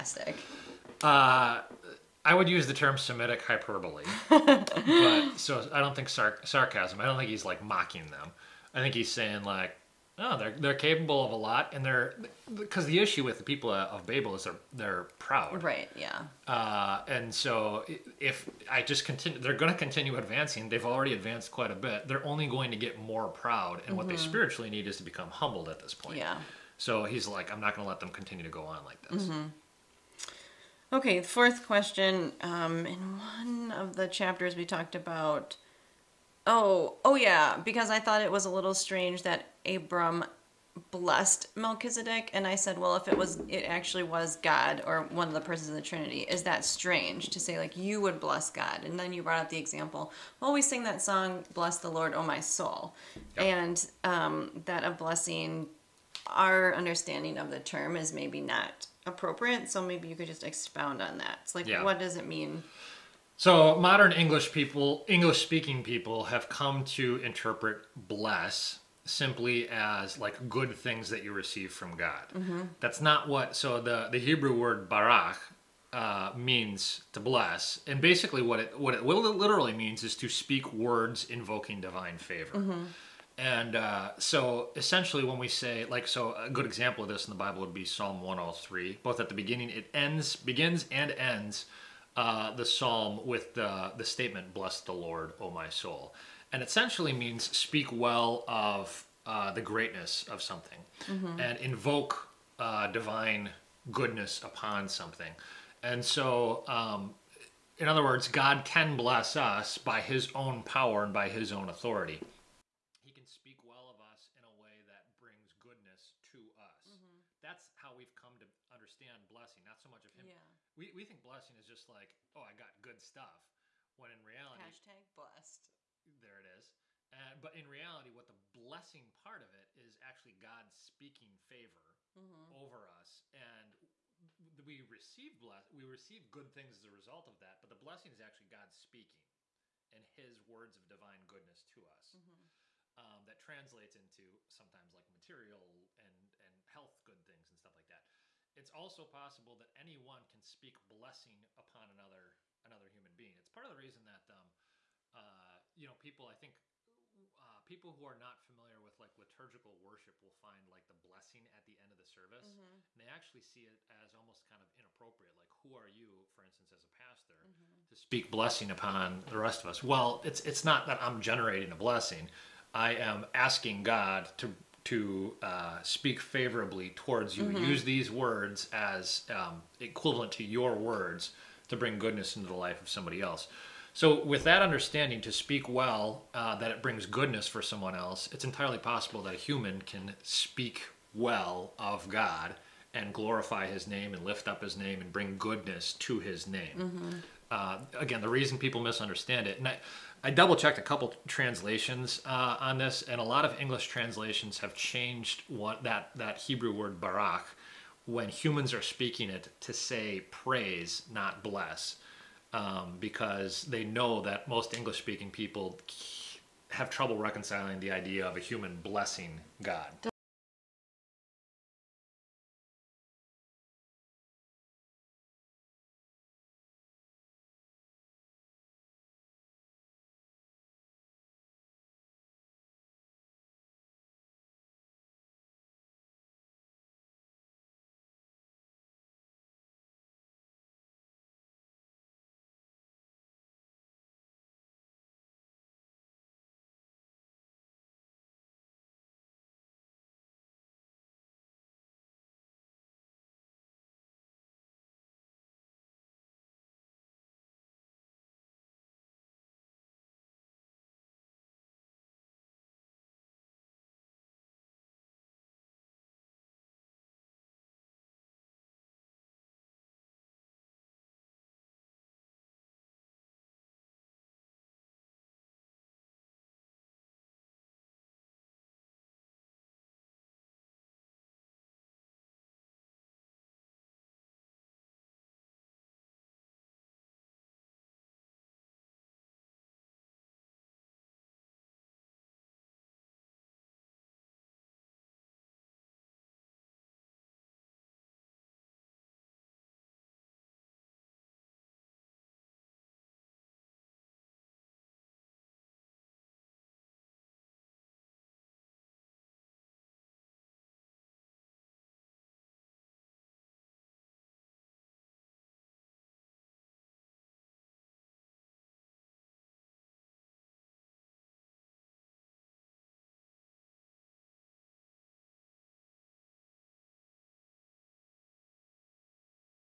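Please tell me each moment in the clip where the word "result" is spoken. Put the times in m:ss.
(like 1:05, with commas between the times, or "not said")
2:16.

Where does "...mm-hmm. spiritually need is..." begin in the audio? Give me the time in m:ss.
0:24.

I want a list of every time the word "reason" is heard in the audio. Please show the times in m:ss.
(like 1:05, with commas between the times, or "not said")
2:33, 3:18.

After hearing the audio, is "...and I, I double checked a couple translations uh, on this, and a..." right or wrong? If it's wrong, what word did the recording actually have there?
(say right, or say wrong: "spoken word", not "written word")
right.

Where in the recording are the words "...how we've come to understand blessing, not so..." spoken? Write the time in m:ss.
1:57.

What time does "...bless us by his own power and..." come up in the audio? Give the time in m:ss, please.
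1:48.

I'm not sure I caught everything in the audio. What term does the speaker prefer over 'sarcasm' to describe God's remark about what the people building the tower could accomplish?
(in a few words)
Semitic hyperbole.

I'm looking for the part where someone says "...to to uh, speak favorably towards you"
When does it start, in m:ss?
2:54.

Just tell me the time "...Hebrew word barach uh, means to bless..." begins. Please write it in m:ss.
1:14.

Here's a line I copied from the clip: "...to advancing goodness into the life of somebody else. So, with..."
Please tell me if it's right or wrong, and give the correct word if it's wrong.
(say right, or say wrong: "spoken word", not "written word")
wrong: "bring", not "advancing".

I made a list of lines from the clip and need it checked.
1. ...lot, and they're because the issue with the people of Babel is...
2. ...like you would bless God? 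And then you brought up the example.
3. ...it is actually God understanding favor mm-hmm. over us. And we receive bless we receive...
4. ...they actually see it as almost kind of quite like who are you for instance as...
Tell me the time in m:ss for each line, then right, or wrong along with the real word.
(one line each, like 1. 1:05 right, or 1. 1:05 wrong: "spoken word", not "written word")
1. 0:11 right
2. 0:47 right
3. 2:09 wrong: "speaking", not "understanding"
4. 2:42 wrong: "inappropriate", not "quite".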